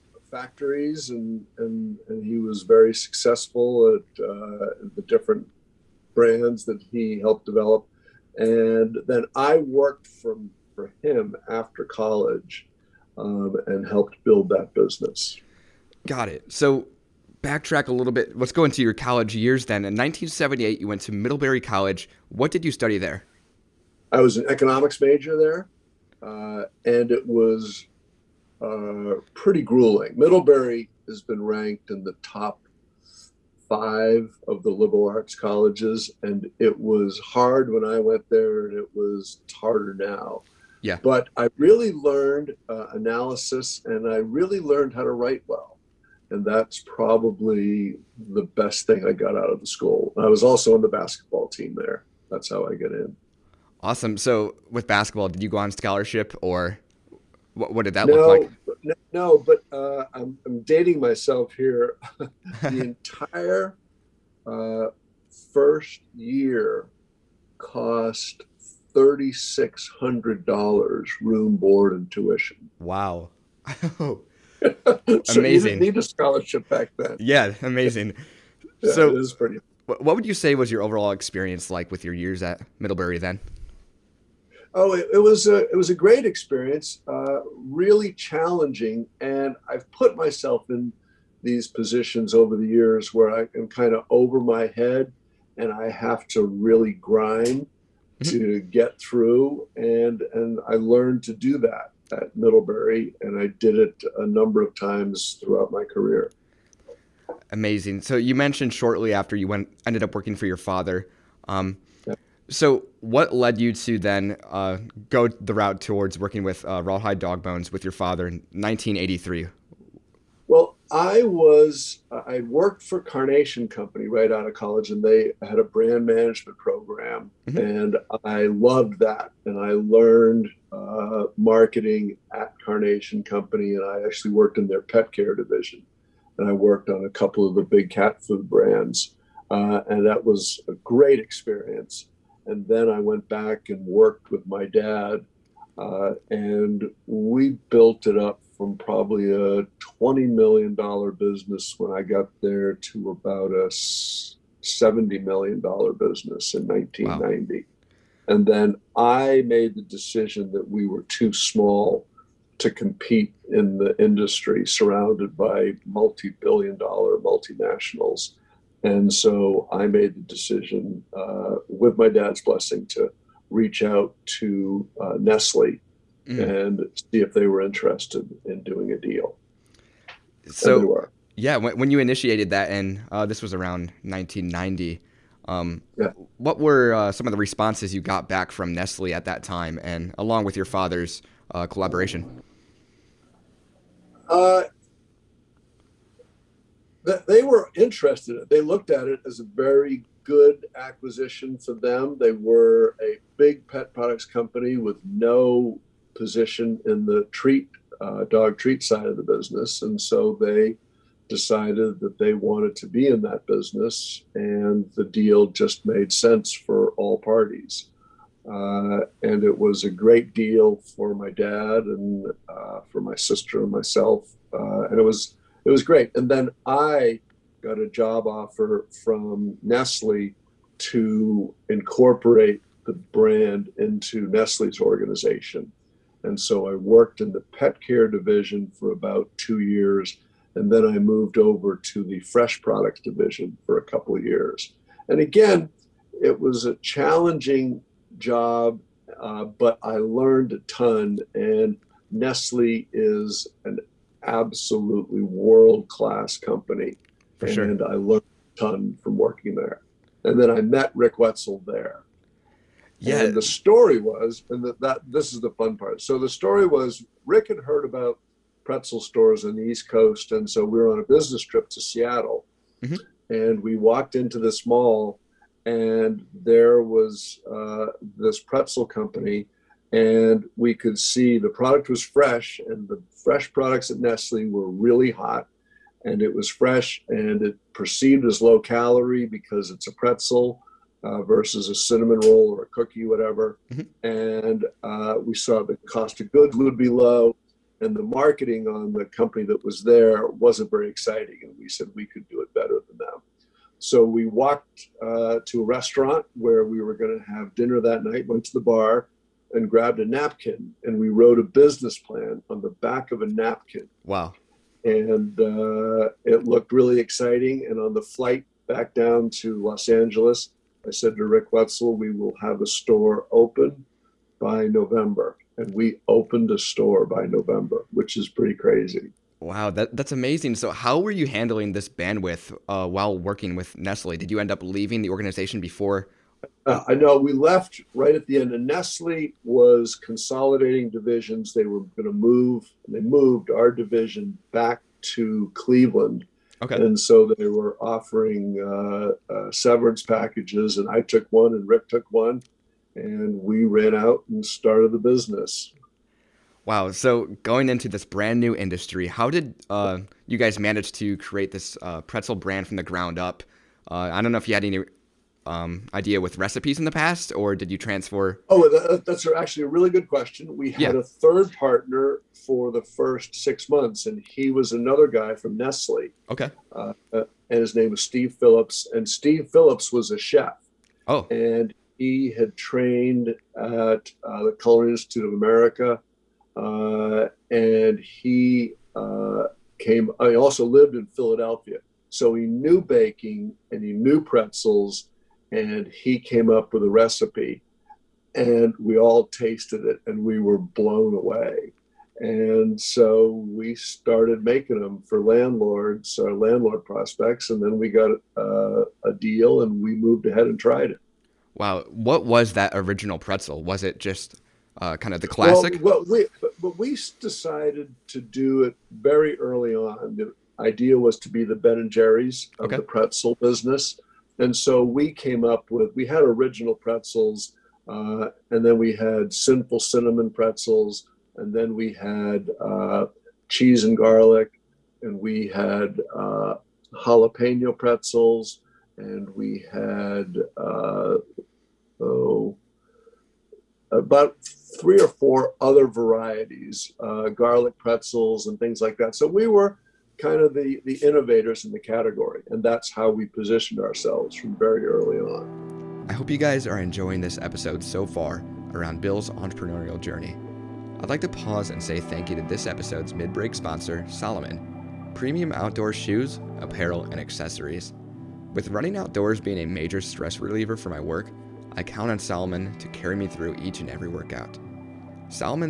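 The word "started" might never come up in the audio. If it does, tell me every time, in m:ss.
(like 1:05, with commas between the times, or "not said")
5:54, 6:43.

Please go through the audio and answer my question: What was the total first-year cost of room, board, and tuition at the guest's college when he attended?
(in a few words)
$3,600.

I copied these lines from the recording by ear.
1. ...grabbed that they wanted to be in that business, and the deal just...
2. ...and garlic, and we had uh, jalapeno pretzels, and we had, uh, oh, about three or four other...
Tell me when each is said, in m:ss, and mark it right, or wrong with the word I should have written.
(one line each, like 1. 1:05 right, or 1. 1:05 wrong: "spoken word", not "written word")
1. 3:31 wrong: "decided", not "grabbed"
2. 7:13 right.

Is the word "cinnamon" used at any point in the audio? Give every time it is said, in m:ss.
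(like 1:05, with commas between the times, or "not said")
4:51, 7:09.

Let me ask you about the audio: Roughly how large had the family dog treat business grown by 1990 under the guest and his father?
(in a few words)
$70 million.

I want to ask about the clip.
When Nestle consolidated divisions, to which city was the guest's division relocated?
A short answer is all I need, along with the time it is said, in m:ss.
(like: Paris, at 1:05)
Cleveland, at 5:45.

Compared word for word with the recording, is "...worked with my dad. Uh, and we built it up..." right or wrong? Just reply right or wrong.
right.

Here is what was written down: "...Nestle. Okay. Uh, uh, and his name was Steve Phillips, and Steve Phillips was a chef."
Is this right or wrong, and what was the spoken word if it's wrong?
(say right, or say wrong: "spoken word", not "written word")
right.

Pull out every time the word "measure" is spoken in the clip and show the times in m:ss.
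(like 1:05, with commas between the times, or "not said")
not said.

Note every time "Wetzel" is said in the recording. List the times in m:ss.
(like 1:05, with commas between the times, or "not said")
4:21, 5:21.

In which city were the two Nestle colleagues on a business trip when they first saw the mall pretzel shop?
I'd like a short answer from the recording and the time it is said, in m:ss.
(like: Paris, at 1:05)
Seattle, at 4:31.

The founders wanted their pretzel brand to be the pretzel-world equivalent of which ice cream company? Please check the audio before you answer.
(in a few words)
Ben and Jerry's.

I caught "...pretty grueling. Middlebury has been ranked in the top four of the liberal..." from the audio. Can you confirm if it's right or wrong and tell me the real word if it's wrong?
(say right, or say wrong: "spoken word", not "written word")
wrong: "five", not "four".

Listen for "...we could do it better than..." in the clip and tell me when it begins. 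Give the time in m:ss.
5:01.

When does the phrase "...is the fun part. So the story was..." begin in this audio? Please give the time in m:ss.
4:25.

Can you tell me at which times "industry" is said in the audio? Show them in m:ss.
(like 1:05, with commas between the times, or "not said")
2:44, 5:58.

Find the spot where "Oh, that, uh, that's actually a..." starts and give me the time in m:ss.
6:08.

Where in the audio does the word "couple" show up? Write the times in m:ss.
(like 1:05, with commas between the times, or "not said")
2:17, 4:03.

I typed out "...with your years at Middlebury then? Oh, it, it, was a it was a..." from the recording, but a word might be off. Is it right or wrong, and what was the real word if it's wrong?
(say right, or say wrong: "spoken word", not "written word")
right.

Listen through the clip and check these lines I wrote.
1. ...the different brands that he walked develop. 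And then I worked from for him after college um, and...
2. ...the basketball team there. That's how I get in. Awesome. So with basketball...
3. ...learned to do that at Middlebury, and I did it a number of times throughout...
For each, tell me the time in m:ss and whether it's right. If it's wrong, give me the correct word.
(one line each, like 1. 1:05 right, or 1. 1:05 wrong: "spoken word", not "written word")
1. 0:04 wrong: "helped", not "walked"
2. 0:50 right
3. 1:40 right.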